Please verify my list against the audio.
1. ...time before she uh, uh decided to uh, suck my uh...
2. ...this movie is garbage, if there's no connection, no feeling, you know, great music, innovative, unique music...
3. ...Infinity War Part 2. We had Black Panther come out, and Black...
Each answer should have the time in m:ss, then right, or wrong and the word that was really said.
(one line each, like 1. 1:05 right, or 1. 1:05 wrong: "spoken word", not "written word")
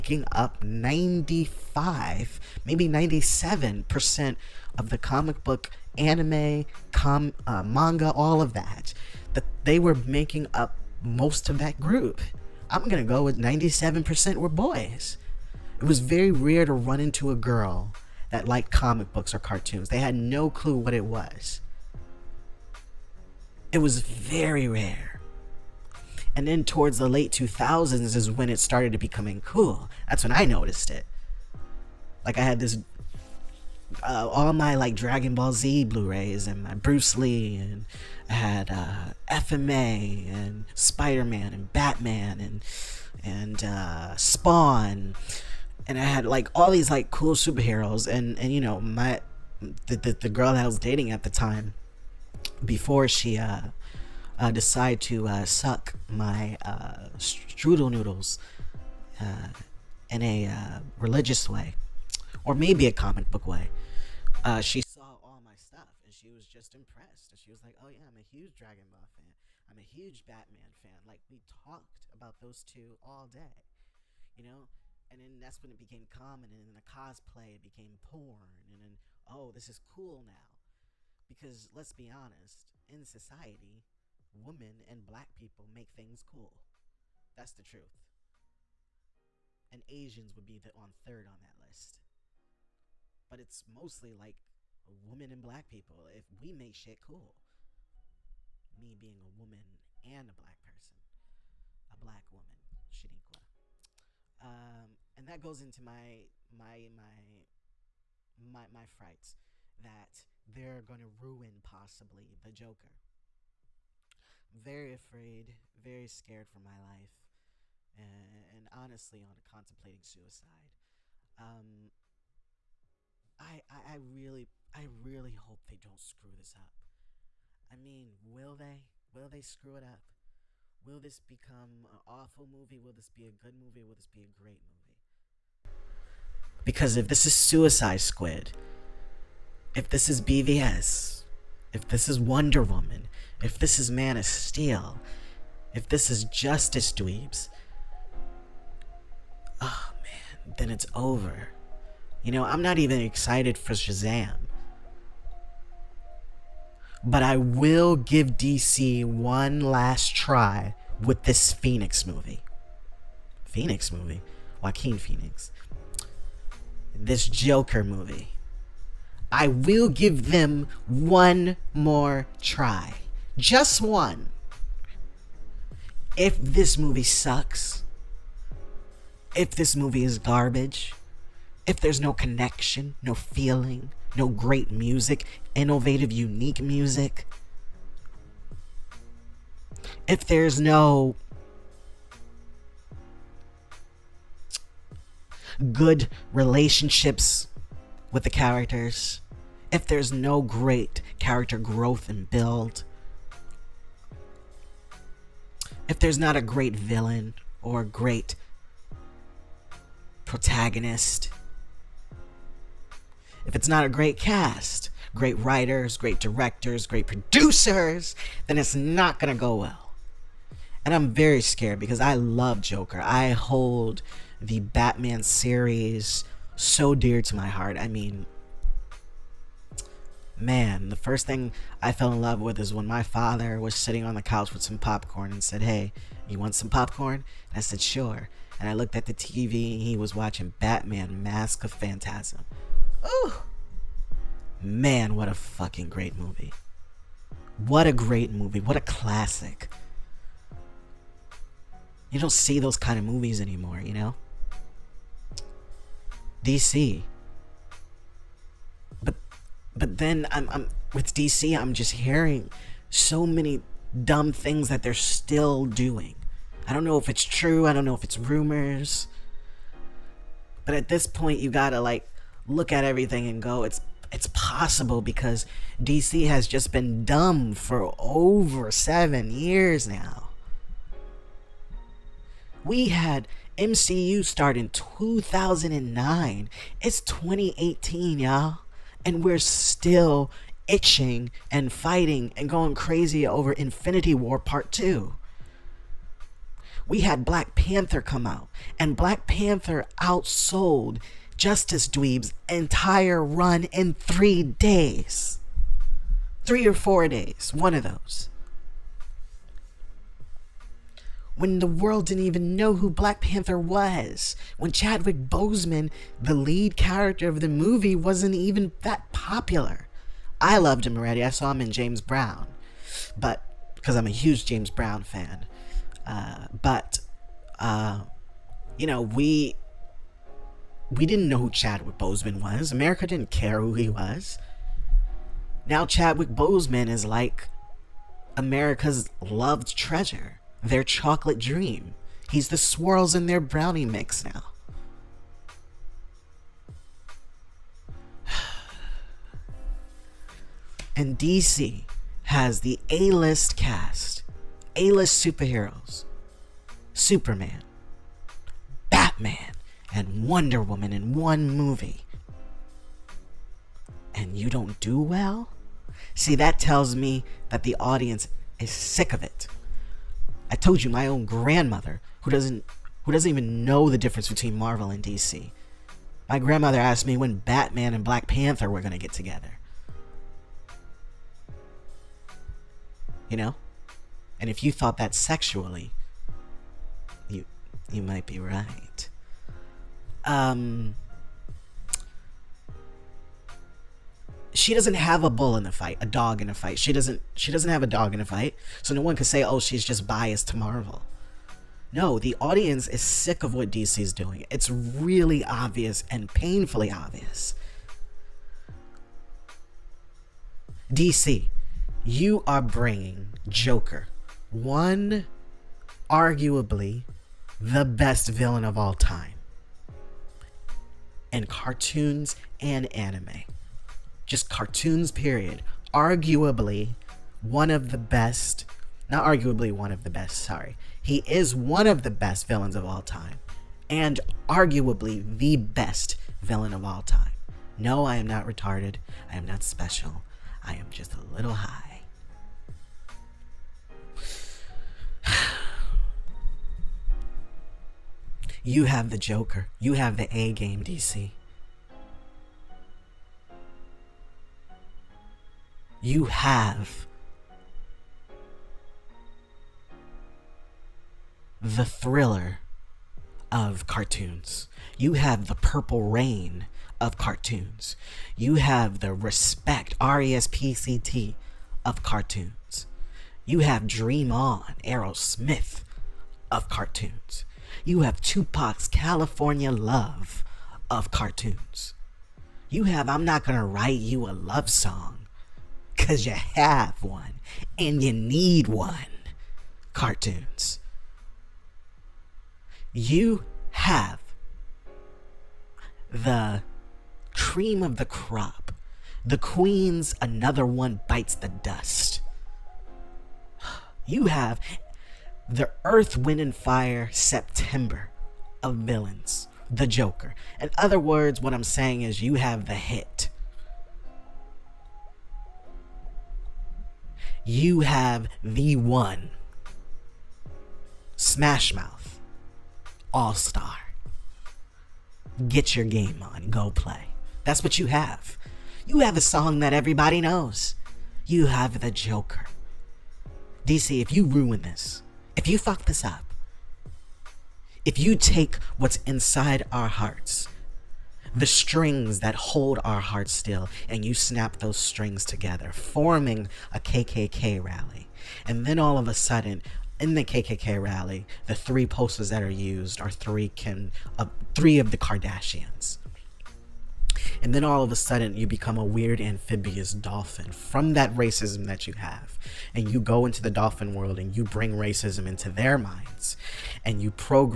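1. 0:51 right
2. 2:59 right
3. 4:53 right.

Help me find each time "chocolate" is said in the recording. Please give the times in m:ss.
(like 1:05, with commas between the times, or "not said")
5:40.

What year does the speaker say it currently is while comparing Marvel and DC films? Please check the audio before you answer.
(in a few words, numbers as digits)
2018.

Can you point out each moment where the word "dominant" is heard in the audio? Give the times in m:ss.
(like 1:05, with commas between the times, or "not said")
not said.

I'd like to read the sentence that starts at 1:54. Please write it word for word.
I'm very afraid, very scared for my life, and, and honestly, on contemplating suicide.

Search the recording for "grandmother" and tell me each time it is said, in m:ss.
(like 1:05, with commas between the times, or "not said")
6:11, 6:16.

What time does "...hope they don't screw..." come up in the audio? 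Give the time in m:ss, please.
2:05.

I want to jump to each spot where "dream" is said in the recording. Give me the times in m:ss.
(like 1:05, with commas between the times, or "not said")
5:41, 7:53.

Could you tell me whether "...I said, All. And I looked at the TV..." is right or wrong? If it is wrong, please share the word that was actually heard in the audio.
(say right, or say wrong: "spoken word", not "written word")
wrong: "Sure", not "All".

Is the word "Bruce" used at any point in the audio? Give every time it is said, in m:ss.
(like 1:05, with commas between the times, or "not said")
0:36.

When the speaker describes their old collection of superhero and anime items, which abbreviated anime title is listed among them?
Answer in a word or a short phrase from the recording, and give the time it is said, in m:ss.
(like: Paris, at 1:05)
FMA, at 0:39.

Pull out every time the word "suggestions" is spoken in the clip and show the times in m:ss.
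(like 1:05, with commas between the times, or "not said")
not said.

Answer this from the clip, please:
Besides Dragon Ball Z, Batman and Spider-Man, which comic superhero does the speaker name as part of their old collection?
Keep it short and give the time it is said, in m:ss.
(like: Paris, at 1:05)
Spawn, at 0:44.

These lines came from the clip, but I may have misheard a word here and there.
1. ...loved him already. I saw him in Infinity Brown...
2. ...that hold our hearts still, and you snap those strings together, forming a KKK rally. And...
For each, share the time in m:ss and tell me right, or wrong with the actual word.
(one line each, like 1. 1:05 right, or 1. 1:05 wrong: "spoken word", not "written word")
1. 5:20 wrong: "James", not "Infinity"
2. 9:02 right.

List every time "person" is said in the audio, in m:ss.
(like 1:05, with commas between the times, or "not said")
1:40.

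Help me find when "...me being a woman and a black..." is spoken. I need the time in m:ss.
1:38.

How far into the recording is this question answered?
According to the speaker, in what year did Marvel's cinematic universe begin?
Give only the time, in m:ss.
4:44.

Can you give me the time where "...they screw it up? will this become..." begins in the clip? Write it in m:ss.
2:09.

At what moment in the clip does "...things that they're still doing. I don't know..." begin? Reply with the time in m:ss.
4:24.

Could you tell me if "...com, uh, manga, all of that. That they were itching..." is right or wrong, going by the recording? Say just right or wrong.
wrong.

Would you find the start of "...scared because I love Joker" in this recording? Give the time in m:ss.
3:41.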